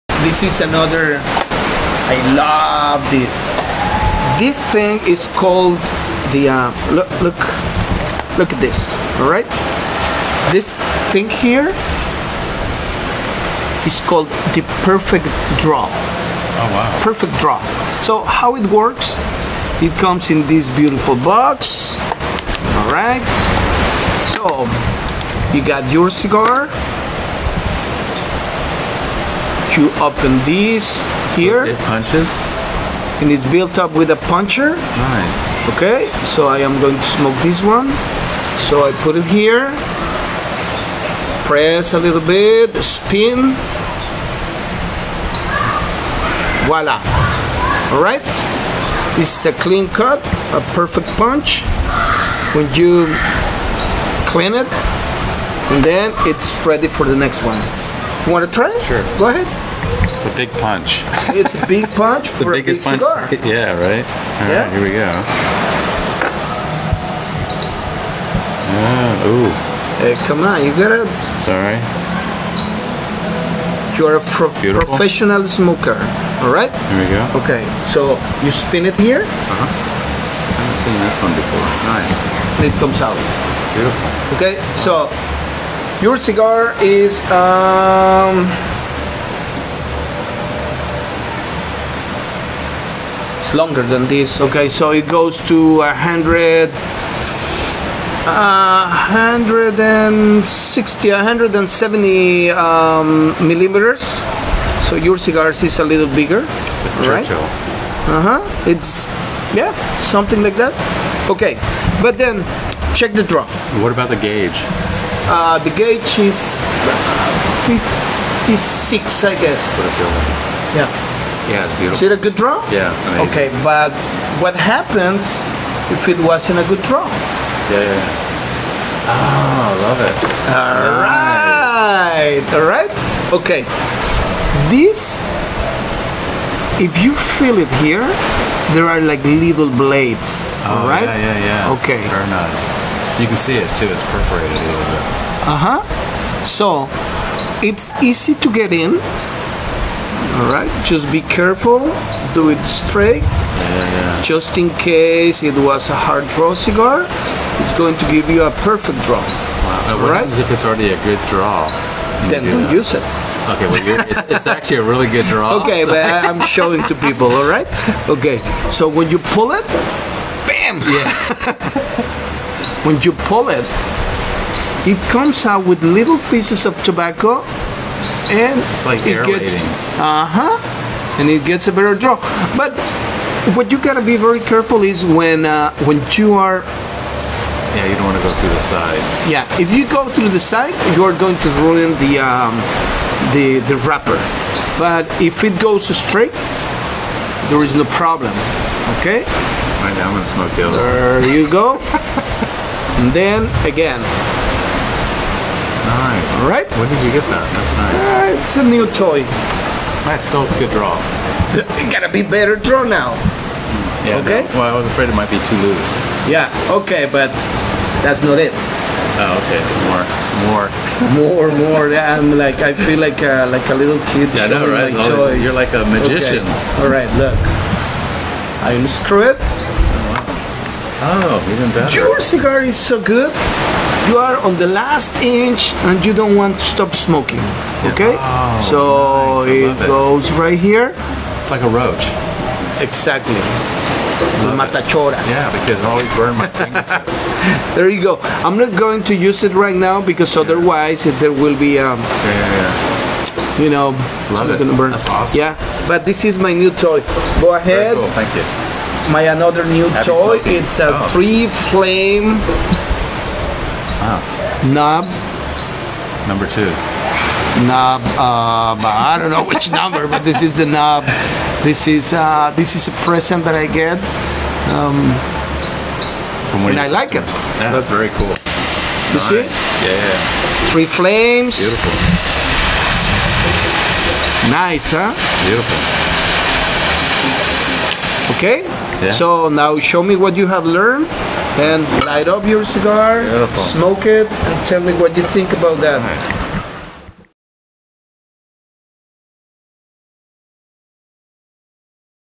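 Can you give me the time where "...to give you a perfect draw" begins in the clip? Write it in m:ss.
2:37.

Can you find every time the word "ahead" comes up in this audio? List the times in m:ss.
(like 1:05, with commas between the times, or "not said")
0:59, 4:17.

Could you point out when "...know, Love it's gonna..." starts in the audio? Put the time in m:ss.
4:13.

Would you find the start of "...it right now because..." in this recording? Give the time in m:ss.
4:09.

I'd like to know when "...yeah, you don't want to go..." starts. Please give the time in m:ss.
3:07.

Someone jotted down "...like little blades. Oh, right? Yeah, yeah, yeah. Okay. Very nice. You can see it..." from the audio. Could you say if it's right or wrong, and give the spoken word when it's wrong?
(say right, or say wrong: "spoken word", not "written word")
right.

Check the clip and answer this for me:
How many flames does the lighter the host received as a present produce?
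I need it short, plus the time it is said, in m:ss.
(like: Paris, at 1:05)
3, at 4:40.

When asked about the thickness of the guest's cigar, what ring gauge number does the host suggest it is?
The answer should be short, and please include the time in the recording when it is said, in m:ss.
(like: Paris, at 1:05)
56, at 1:57.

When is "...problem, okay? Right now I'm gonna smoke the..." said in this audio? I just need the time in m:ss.
3:17.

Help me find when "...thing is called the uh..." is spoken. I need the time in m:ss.
0:04.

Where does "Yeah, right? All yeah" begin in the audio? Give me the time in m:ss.
1:03.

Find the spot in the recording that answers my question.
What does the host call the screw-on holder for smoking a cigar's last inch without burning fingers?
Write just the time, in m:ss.
4:04.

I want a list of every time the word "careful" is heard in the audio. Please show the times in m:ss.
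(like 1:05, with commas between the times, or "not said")
2:31, 3:04.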